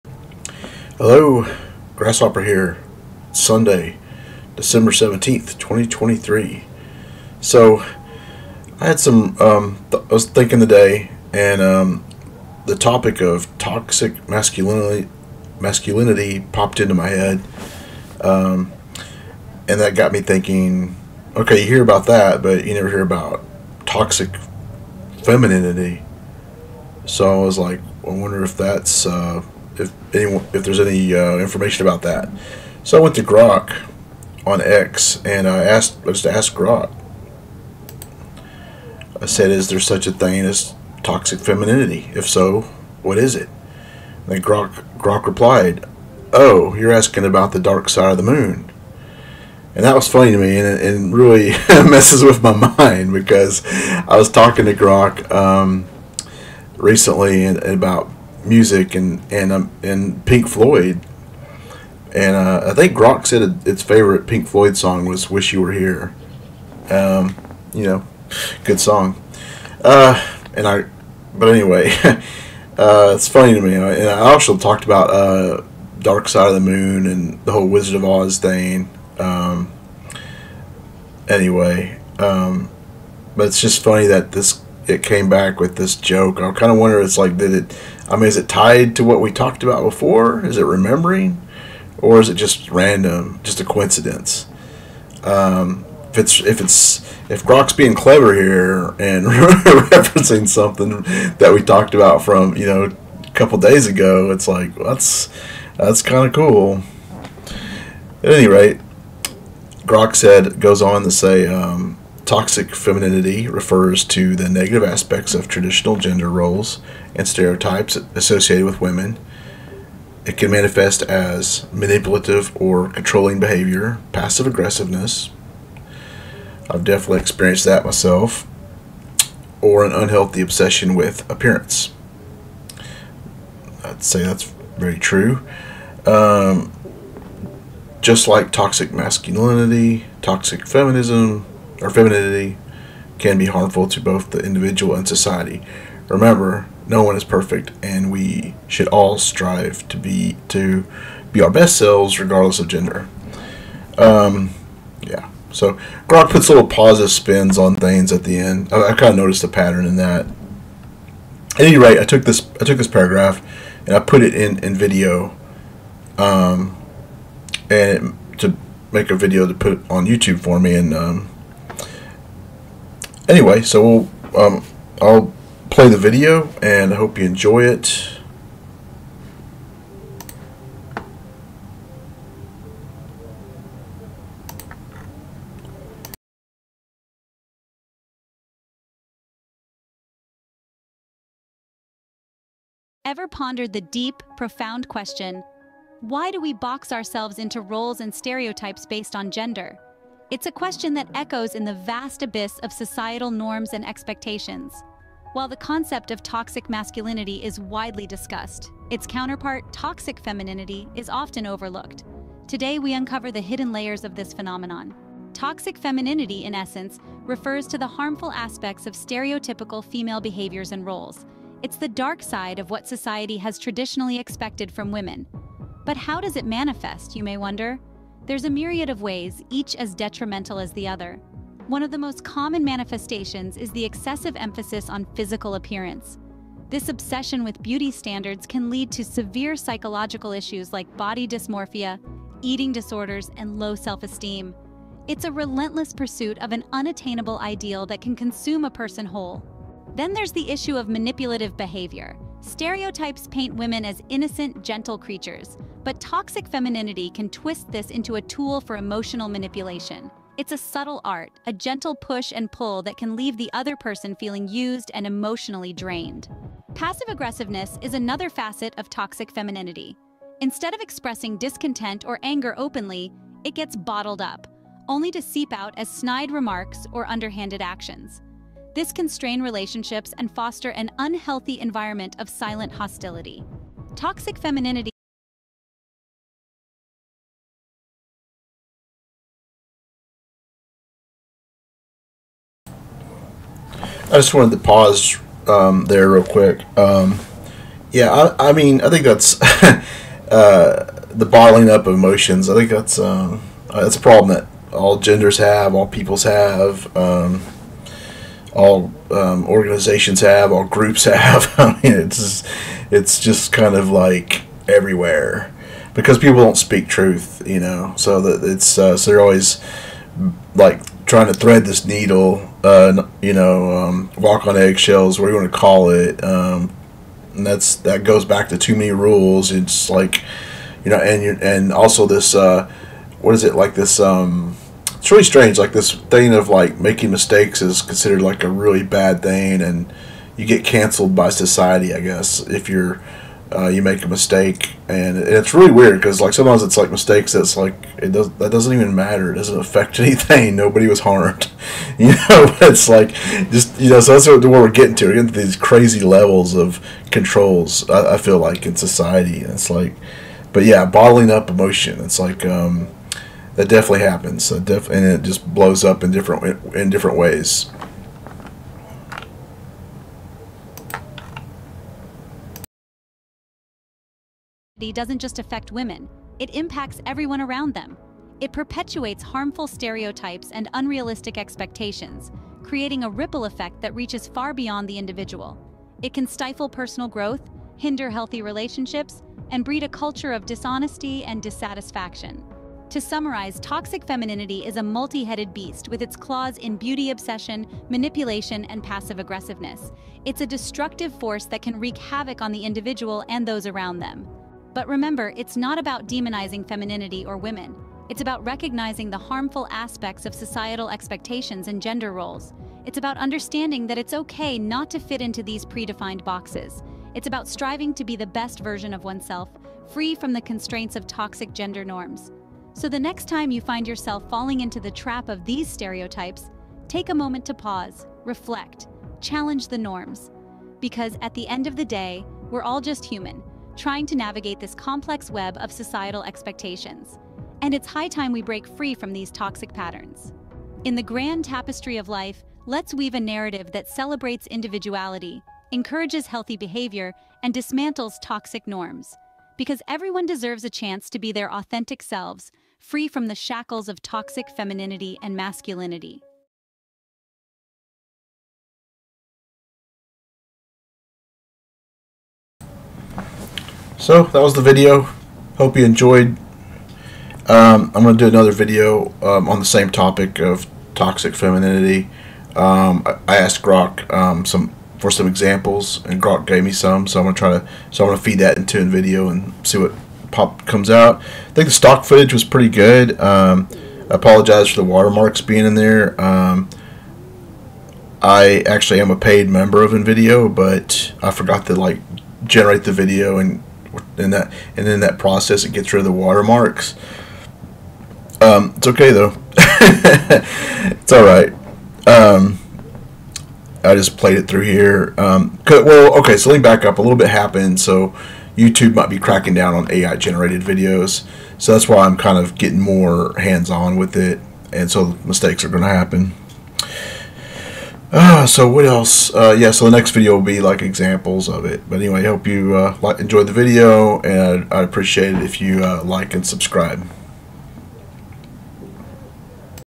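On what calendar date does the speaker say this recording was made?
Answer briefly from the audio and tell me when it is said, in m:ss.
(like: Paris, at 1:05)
December 17th, 2023, at 0:04.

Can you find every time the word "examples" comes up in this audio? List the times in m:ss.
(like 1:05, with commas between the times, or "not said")
7:55, 8:40.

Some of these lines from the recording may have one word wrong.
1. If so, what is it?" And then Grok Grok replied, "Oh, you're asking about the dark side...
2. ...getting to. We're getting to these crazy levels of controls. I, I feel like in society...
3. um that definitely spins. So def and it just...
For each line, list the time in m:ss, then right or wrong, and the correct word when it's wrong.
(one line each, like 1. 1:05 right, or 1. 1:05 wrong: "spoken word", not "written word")
1. 0:42 right
2. 5:54 right
3. 6:02 wrong: "happens", not "spins".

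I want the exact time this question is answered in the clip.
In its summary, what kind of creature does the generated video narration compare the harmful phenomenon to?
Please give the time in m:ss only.
6:34.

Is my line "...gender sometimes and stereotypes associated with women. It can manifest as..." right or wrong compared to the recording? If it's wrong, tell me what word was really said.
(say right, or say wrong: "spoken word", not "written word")
wrong: "roles", not "sometimes".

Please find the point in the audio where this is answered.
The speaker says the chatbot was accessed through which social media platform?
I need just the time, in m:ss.
0:34.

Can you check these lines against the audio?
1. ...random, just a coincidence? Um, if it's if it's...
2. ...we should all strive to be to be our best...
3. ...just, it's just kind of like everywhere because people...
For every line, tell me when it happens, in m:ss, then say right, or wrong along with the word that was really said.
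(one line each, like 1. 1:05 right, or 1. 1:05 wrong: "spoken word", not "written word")
1. 1:32 right
2. 2:28 right
3. 5:12 right.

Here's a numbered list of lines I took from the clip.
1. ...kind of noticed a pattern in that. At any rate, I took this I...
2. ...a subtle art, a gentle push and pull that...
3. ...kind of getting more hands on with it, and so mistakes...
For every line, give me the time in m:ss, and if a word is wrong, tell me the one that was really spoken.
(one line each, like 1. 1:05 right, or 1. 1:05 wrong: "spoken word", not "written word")
1. 2:38 right
2. 4:20 right
3. 8:32 right.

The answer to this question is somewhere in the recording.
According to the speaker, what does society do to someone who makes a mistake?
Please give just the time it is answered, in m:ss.
5:40.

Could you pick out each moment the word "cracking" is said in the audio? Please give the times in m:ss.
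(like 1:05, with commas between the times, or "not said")
8:29.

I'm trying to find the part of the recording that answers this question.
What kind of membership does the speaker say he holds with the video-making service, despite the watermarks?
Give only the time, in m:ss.
8:09.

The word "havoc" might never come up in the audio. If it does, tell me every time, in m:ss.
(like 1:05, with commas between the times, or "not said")
6:41.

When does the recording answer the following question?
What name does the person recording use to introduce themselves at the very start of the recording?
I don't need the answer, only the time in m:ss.
0:01.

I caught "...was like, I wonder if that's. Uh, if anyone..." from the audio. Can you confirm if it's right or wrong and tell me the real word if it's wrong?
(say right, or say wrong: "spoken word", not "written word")
right.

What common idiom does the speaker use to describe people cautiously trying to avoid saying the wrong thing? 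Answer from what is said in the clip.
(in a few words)
walk on eggshells.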